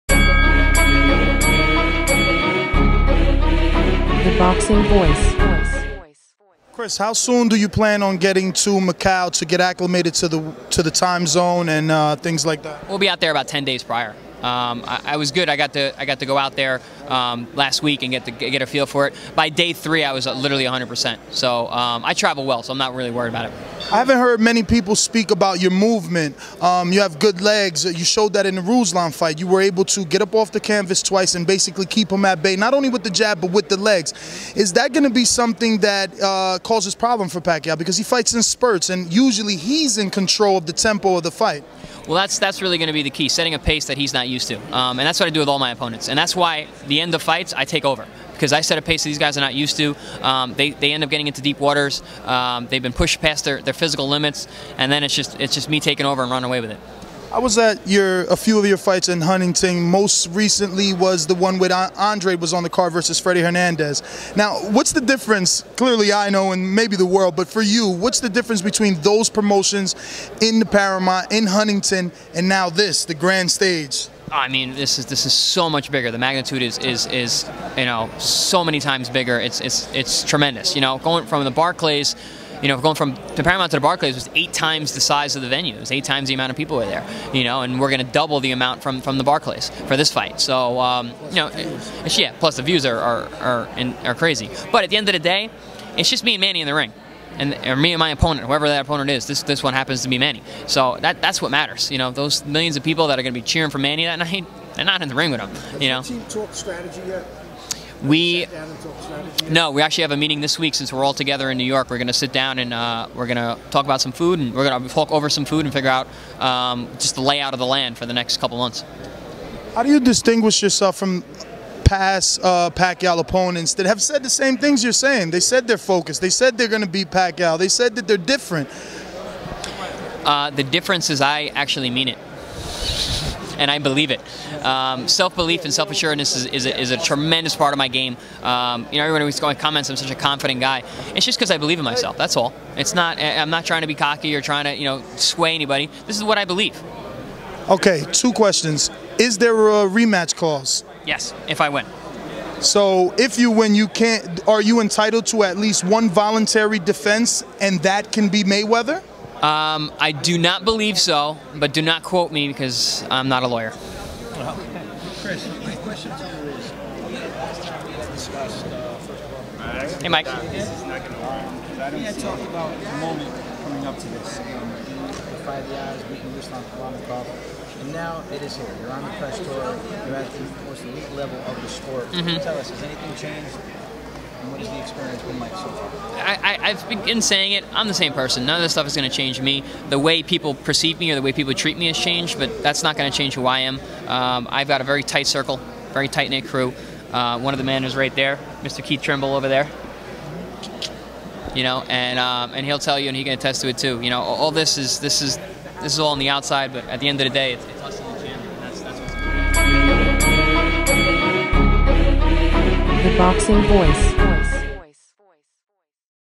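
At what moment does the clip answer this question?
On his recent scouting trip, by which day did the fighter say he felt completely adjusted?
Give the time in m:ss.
0:19.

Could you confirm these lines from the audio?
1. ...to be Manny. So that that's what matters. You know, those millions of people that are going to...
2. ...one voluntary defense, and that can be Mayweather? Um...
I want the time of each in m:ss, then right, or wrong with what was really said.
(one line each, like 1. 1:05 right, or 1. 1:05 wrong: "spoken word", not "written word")
1. 1:40 right
2. 2:35 right.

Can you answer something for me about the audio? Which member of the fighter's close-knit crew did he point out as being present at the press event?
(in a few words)
Keith Trimble.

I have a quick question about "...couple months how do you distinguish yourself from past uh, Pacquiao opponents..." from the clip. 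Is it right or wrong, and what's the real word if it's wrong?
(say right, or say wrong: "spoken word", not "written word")
right.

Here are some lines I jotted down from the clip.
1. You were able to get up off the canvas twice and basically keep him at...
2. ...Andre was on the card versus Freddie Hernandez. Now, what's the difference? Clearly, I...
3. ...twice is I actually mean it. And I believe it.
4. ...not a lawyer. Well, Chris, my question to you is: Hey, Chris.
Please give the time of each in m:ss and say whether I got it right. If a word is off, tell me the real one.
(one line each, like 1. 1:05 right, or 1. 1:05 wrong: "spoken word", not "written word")
1. 0:29 right
2. 1:01 right
3. 2:10 wrong: "difference", not "twice"
4. 2:43 wrong: "Mike", not "Chris".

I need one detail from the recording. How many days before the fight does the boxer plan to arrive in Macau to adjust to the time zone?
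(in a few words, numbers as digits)
10 days.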